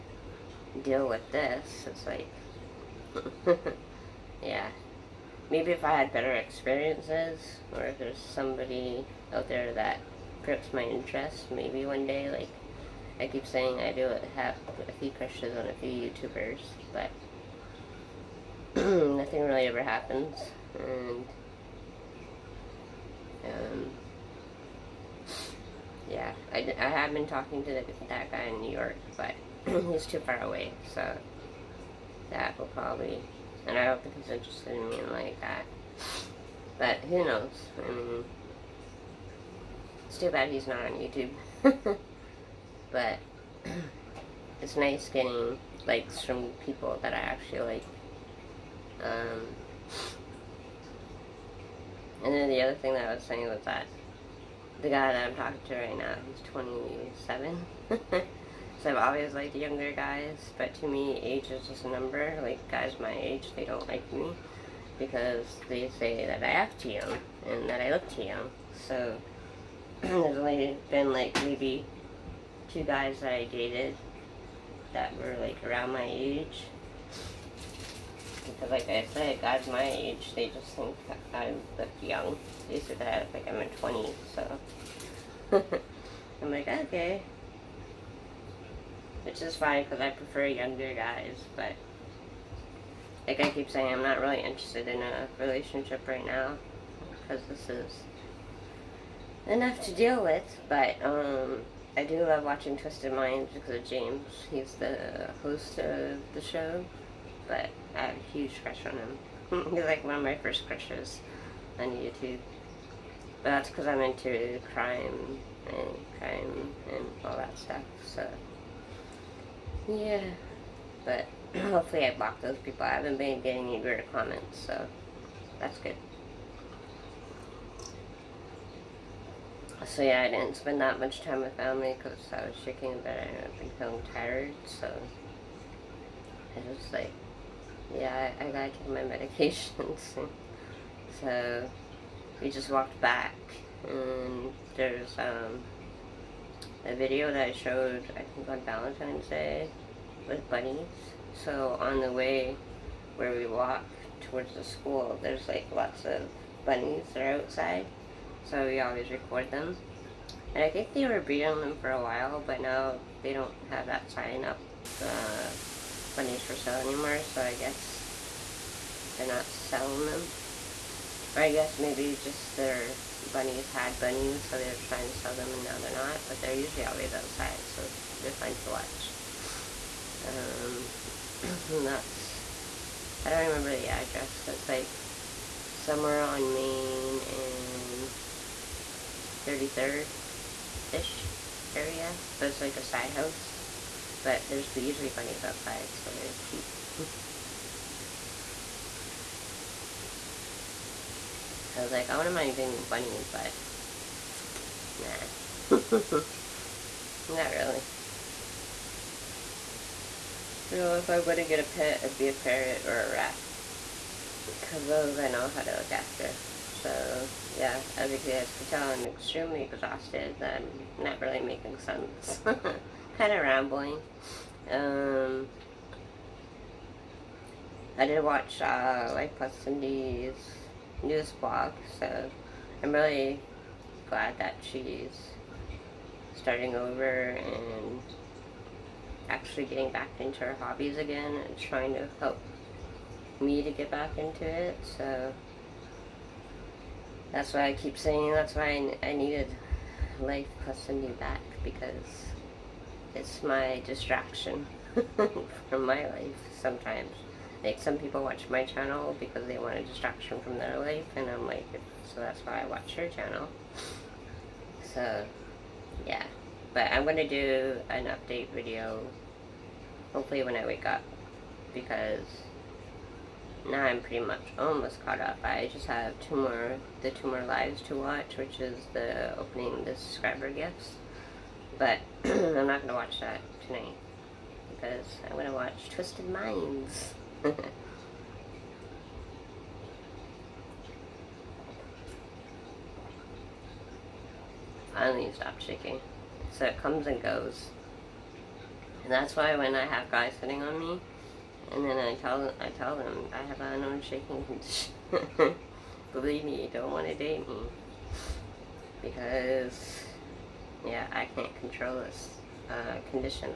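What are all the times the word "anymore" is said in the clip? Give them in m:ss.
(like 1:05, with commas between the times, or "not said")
2:46.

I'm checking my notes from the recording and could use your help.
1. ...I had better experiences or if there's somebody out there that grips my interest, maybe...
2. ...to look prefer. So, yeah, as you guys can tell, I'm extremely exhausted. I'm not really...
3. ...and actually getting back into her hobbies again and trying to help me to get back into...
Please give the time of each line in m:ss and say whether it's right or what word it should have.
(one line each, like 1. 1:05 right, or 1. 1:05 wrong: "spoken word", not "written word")
1. 0:05 right
2. 3:35 wrong: "after", not "prefer"
3. 3:57 right.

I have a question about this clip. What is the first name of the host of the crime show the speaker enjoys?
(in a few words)
James.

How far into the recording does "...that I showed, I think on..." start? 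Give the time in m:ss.
2:27.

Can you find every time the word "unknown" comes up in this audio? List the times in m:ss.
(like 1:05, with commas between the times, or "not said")
5:03.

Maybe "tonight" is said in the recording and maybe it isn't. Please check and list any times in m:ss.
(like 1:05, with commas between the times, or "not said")
4:43.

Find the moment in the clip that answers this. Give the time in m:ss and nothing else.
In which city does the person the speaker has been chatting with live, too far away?
0:28.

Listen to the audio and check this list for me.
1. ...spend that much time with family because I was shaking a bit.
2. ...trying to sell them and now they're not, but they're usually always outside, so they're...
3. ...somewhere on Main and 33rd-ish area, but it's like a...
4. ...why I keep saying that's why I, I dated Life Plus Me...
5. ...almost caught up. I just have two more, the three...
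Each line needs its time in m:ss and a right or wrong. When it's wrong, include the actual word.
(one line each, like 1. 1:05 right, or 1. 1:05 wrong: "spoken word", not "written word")
1. 2:10 right
2. 2:54 right
3. 3:05 right
4. 4:07 wrong: "needed", not "dated"
5. 4:34 wrong: "two", not "three".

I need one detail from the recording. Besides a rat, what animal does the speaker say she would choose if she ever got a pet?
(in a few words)
Ferret.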